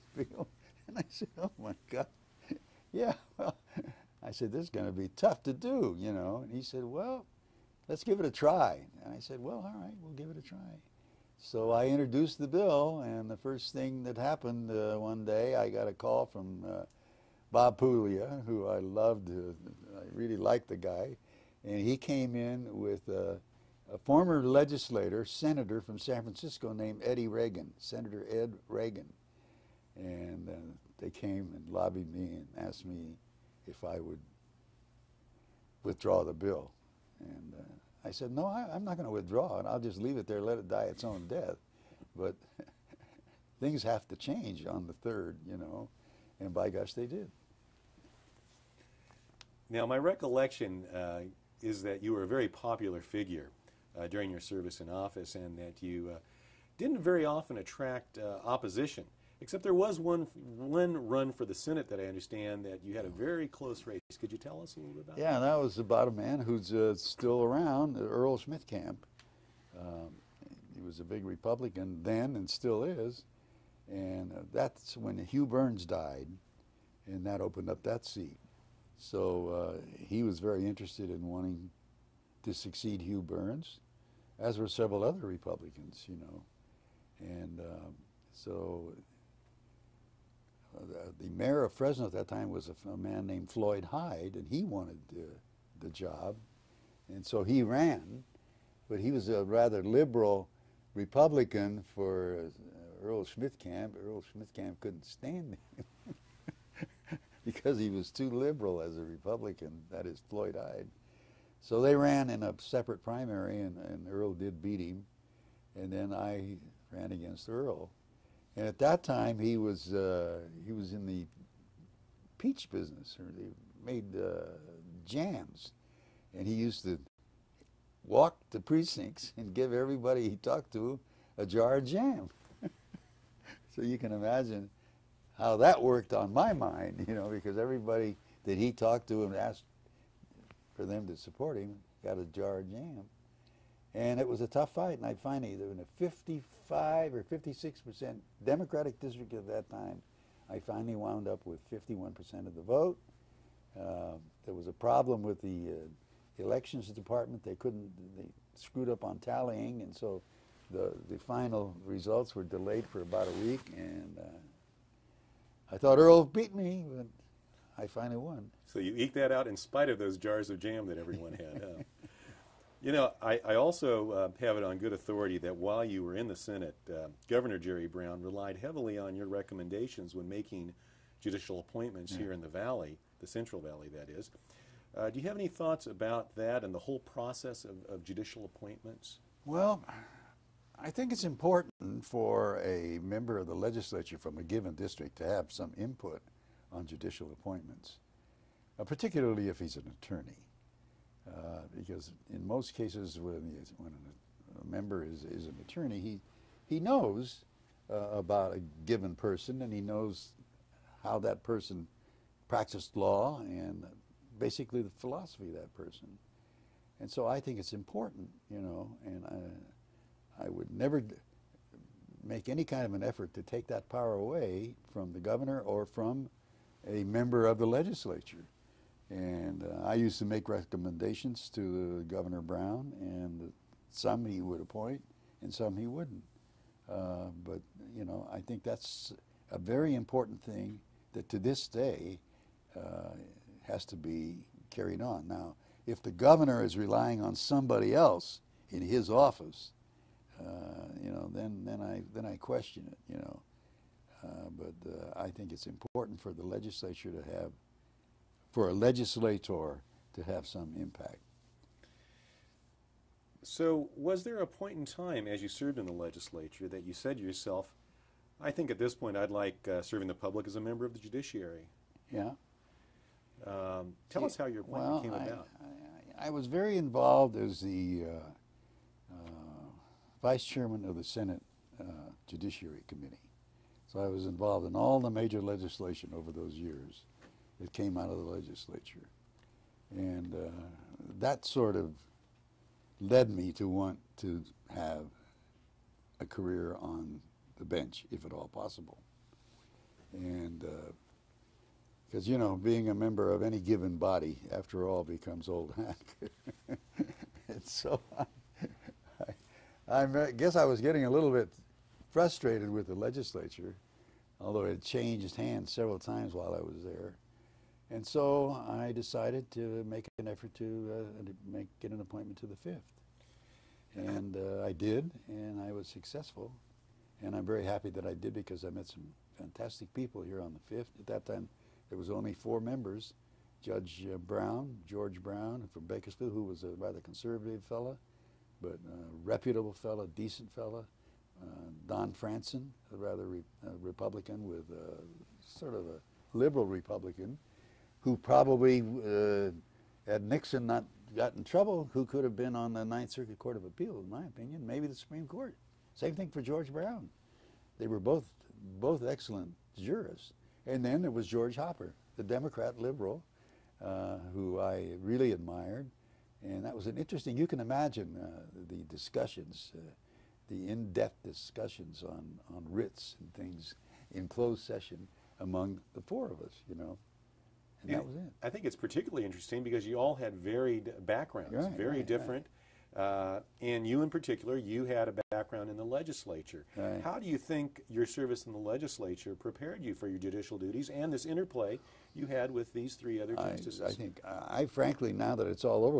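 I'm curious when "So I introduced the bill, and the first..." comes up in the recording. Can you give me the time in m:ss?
0:11.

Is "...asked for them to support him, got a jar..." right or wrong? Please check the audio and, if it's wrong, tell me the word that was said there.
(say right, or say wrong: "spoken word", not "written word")
right.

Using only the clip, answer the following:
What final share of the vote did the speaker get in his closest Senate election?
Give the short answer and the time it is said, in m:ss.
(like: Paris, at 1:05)
51 percent, at 2:31.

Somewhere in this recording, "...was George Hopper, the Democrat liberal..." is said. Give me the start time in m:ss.
6:01.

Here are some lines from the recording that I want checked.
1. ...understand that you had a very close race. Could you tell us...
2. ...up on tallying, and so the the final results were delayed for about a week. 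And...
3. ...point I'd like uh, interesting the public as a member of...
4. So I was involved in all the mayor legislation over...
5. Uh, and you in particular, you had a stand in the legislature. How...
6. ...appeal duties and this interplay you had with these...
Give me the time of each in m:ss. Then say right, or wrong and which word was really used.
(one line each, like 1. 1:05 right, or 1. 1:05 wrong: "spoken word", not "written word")
1. 1:02 right
2. 2:38 right
3. 4:28 wrong: "serving", not "interesting"
4. 4:43 wrong: "major", not "mayor"
5. 6:22 wrong: "background", not "stand"
6. 6:30 wrong: "judicial", not "appeal".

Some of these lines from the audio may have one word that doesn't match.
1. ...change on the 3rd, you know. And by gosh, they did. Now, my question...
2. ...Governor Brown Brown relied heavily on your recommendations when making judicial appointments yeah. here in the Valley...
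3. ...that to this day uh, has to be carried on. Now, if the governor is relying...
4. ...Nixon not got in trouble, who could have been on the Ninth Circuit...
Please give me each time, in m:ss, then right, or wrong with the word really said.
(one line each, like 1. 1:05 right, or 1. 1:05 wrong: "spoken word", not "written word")
1. 0:44 wrong: "recollection", not "question"
2. 2:57 wrong: "Jerry", not "Brown"
3. 4:01 right
4. 5:50 right.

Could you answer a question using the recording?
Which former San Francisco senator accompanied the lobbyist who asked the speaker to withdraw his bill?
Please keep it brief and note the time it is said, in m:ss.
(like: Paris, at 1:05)
Ed Reagan, at 0:27.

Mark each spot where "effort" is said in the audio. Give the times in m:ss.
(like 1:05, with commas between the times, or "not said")
3:43, 5:20.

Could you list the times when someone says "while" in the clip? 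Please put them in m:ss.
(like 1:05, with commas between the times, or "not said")
2:55, 5:16.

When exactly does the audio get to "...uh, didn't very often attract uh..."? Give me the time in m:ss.
0:56.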